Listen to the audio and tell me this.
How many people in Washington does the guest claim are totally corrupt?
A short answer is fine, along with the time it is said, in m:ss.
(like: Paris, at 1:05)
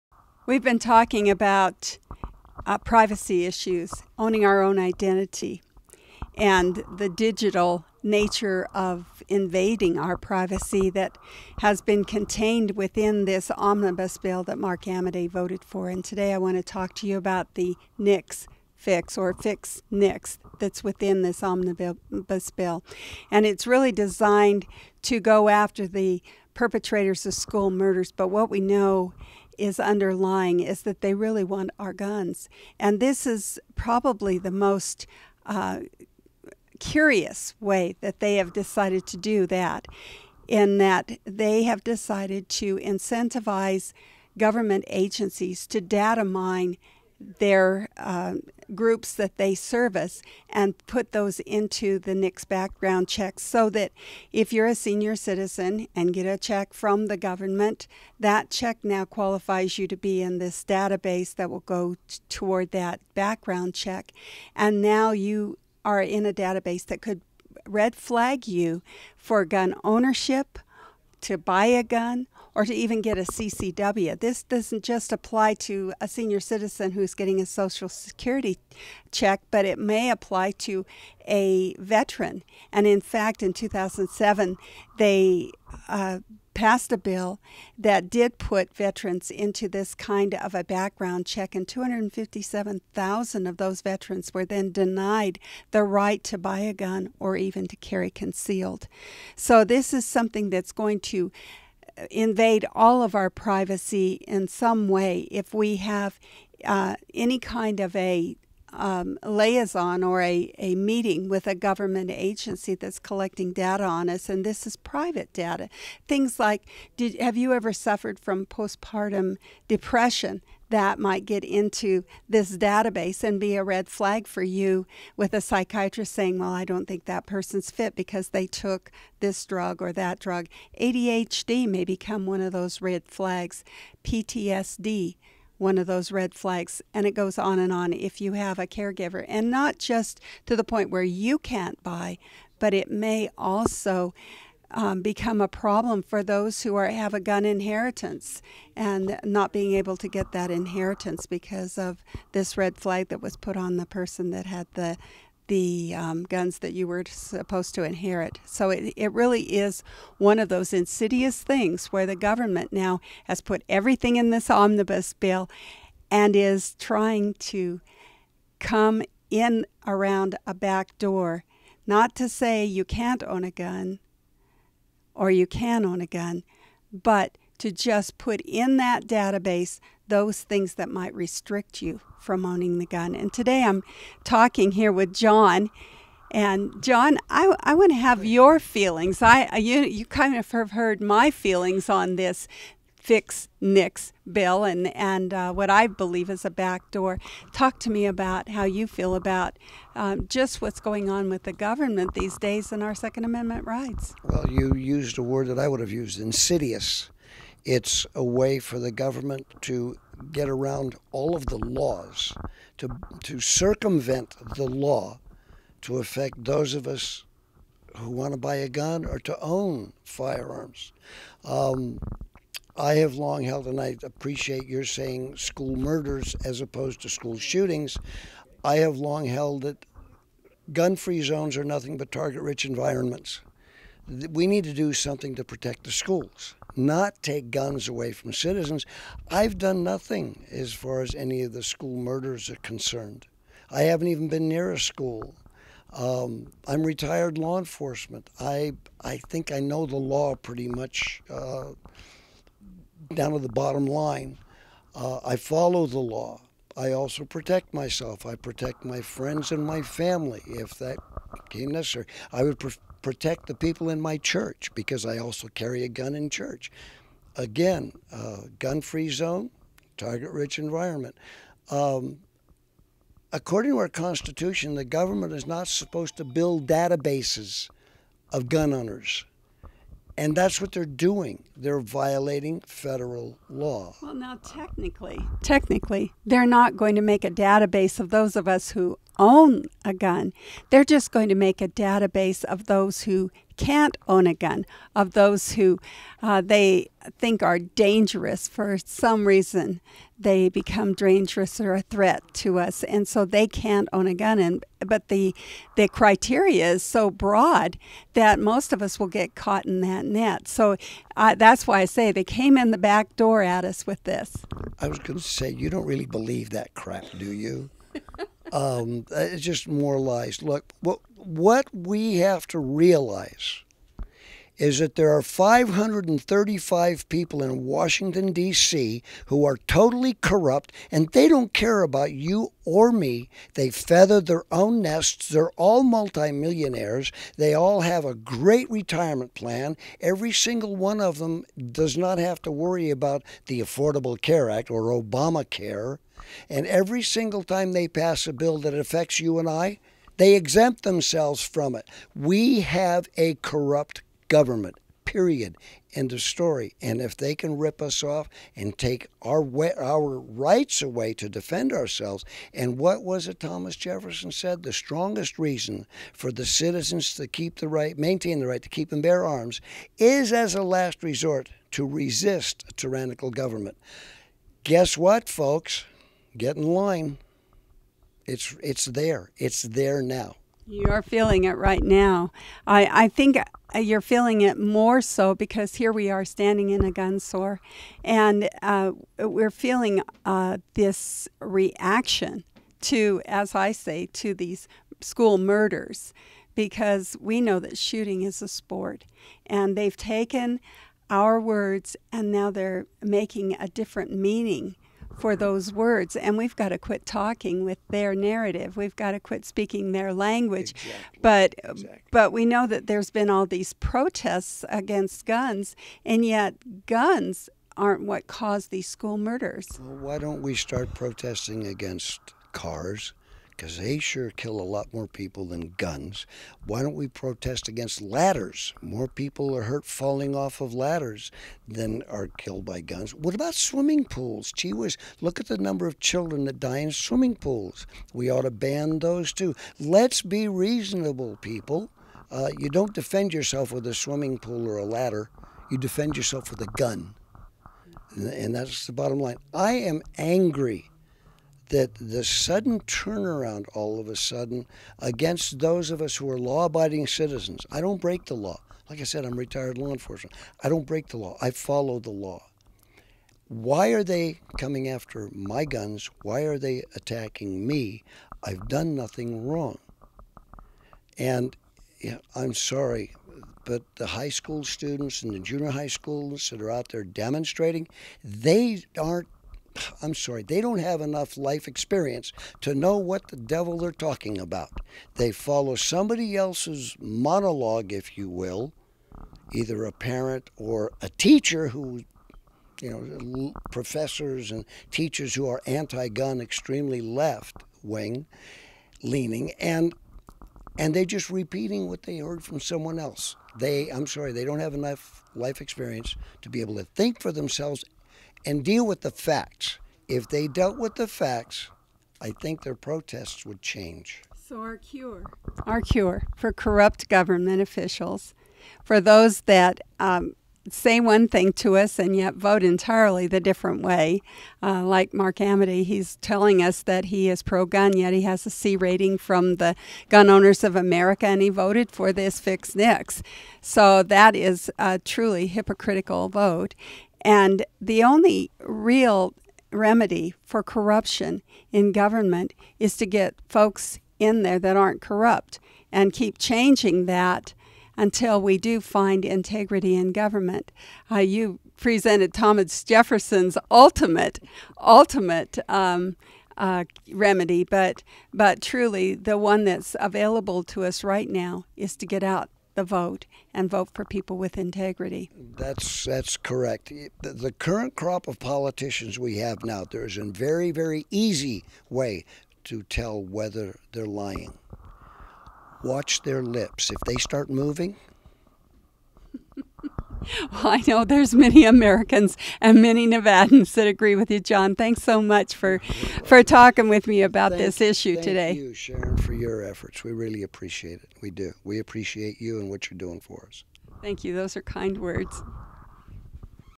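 535, at 5:25.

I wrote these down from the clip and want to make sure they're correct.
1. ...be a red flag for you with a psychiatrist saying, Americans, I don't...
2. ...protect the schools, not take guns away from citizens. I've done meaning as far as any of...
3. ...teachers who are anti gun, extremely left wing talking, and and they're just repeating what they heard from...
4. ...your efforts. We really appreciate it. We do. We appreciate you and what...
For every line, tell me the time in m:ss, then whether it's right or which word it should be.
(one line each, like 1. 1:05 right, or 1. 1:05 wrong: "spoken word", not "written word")
1. 2:03 wrong: "Well", not "Americans"
2. 3:55 wrong: "nothing", not "meaning"
3. 8:14 wrong: "leaning", not "talking"
4. 9:49 right.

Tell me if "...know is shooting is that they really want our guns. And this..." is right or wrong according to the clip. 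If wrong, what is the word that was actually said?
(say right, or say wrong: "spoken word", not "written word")
wrong: "underlying", not "shooting".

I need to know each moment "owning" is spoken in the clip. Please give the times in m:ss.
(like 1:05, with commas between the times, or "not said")
0:04, 3:02.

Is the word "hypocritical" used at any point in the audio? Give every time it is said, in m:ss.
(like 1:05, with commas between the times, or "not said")
8:55.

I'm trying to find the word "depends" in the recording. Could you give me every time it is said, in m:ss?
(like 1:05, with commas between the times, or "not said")
not said.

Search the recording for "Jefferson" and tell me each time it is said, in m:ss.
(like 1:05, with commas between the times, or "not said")
6:03, 9:12.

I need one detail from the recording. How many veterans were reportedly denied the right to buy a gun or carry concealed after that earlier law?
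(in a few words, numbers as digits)
257,000.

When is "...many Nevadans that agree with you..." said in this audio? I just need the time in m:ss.
9:42.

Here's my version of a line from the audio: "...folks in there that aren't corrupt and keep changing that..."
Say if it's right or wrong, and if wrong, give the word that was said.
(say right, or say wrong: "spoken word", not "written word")
right.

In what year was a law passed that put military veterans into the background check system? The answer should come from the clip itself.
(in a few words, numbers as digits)
2007.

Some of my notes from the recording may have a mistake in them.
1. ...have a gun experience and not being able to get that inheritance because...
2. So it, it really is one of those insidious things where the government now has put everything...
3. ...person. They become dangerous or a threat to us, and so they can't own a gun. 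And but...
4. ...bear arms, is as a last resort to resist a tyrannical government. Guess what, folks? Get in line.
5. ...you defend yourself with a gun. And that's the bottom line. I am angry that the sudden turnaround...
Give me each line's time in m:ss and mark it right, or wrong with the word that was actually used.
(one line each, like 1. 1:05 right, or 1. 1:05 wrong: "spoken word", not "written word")
1. 2:26 wrong: "inheritance", not "experience"
2. 2:38 right
3. 4:59 wrong: "reason", not "person"
4. 6:09 right
5. 7:25 right.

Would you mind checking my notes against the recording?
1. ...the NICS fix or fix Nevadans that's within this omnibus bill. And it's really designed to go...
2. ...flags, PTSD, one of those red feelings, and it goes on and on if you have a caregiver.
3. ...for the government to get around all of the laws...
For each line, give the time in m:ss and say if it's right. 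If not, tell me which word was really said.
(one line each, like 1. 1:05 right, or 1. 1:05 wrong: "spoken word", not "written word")
1. 0:17 wrong: "NICS", not "Nevadans"
2. 2:13 wrong: "flags", not "feelings"
3. 3:28 right.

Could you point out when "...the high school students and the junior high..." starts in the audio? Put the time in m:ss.
7:53.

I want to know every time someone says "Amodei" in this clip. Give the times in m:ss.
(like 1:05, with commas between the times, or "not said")
0:14, 8:45.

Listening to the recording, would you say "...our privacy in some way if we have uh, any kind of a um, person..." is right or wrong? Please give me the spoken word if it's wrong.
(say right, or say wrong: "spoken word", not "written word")
wrong: "liaison", not "person".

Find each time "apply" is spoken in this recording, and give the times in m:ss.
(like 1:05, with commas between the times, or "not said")
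1:15, 1:20.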